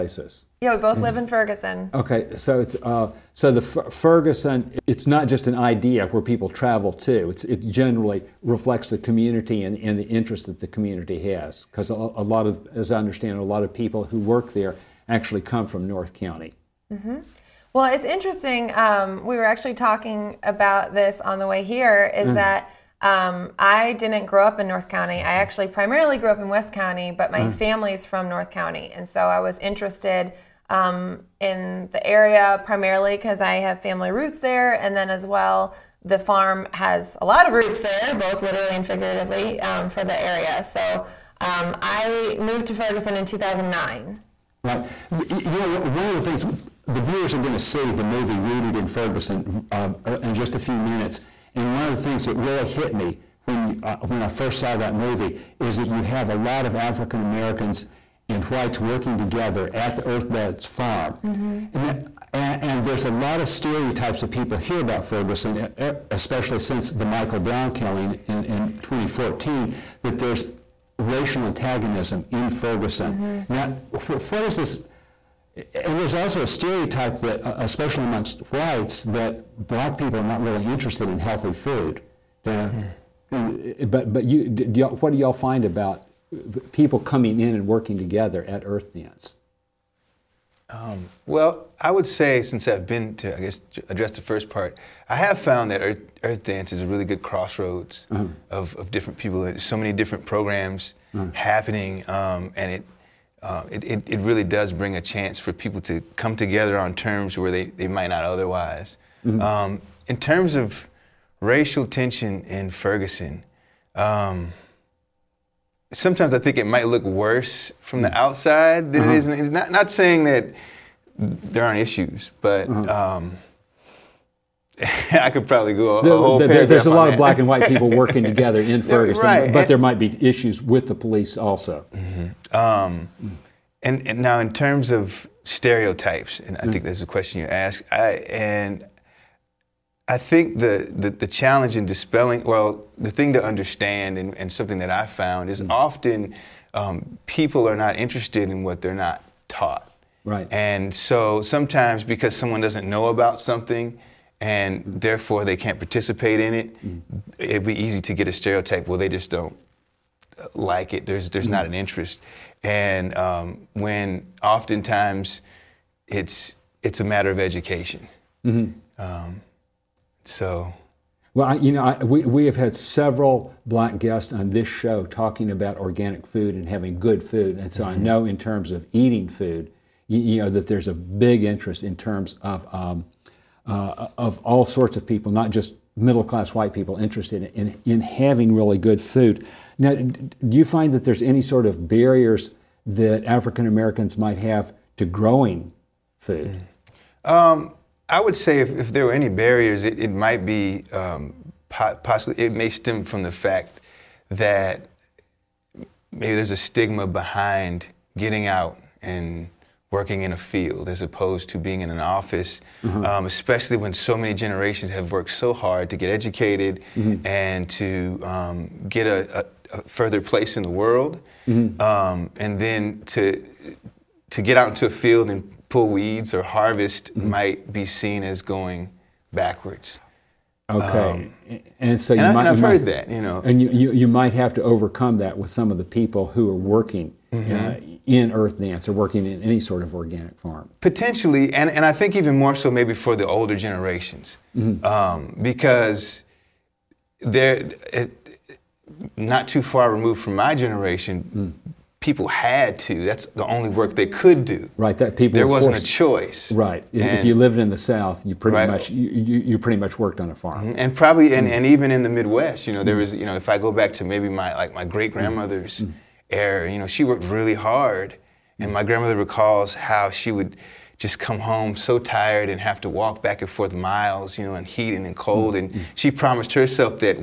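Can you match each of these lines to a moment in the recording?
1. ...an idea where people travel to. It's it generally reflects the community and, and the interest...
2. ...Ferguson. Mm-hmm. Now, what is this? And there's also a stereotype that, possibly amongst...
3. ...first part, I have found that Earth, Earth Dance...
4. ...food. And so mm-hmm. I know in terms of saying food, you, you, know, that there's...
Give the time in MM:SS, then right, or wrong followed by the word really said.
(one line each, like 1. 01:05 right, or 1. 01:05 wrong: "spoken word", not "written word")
1. 00:05 right
2. 01:12 wrong: "especially", not "possibly"
3. 01:34 right
4. 02:57 wrong: "eating", not "saying".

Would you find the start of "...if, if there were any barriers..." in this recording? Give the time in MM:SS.
03:18.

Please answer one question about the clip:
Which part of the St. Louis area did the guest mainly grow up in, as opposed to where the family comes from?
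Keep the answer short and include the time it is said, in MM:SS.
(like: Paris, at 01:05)
West County, at 00:26.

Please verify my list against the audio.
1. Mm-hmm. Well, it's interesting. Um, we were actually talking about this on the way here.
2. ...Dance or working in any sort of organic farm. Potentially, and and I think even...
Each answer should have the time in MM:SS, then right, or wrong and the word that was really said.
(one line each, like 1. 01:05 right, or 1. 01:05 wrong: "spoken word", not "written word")
1. 00:16 right
2. 03:58 right.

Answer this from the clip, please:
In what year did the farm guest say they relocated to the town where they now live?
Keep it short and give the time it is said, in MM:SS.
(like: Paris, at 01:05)
2009, at 00:43.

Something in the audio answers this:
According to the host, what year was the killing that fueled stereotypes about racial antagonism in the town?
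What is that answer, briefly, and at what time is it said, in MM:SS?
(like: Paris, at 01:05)
2014, at 01:08.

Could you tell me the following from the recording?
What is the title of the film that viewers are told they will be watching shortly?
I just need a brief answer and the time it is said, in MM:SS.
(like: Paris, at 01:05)
Rooted in Ferguson, at 00:48.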